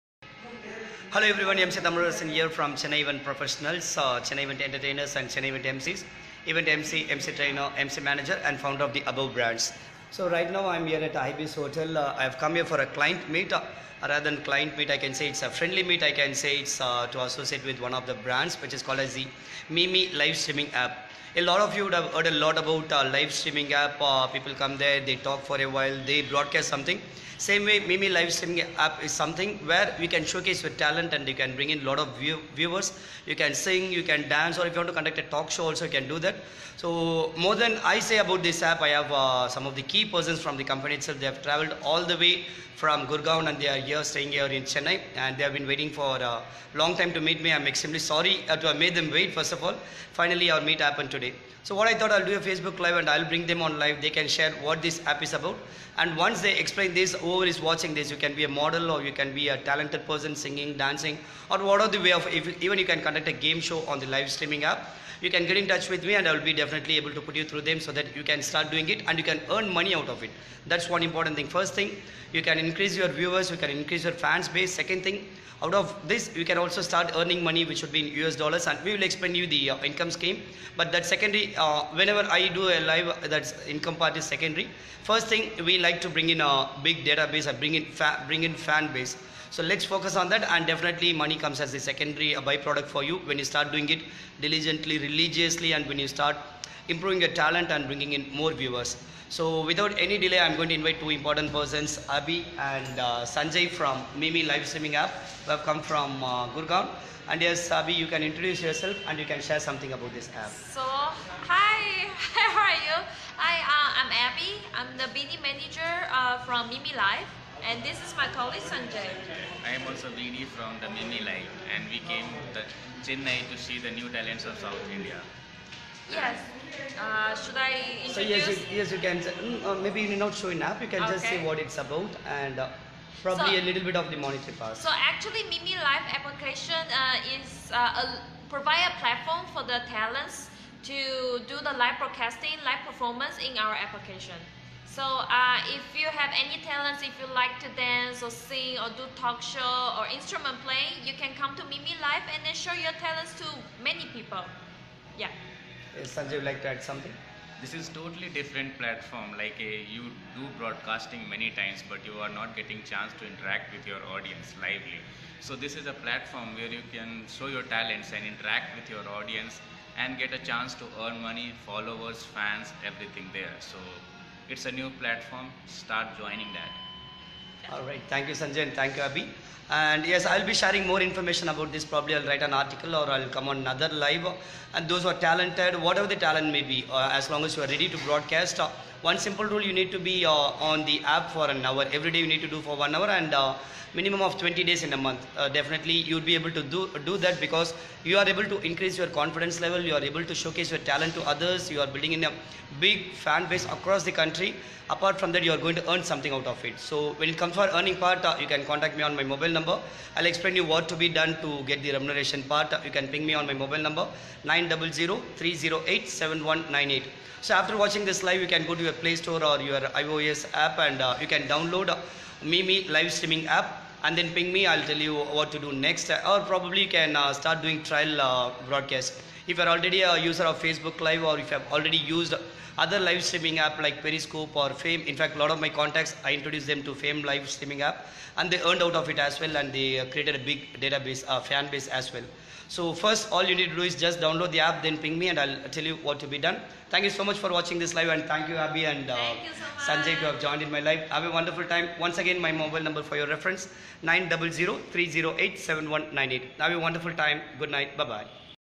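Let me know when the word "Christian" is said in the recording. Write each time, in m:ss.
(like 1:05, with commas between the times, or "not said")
not said.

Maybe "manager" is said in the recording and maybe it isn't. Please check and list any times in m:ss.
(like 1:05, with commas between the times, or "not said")
0:07, 1:55.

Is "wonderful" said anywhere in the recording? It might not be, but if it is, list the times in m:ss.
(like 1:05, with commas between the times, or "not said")
4:11, 4:16.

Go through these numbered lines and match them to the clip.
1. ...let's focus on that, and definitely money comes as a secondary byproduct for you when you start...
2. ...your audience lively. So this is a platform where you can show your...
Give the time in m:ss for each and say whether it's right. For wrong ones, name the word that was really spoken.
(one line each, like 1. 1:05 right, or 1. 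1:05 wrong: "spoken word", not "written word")
1. 1:29 right
2. 2:43 right.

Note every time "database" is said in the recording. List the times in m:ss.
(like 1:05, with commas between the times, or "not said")
1:27, 4:00.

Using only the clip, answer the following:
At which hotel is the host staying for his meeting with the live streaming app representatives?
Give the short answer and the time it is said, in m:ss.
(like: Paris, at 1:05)
Ibis Hotel, at 0:11.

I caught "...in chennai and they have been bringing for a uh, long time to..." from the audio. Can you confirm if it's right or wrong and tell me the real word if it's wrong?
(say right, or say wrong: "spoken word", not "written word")
wrong: "waiting", not "bringing".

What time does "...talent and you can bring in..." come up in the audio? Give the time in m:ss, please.
0:30.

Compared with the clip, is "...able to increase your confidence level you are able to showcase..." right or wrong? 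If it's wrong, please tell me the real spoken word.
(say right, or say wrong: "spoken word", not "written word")
right.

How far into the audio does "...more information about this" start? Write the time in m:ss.
3:00.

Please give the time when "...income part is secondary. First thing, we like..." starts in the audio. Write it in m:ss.
1:23.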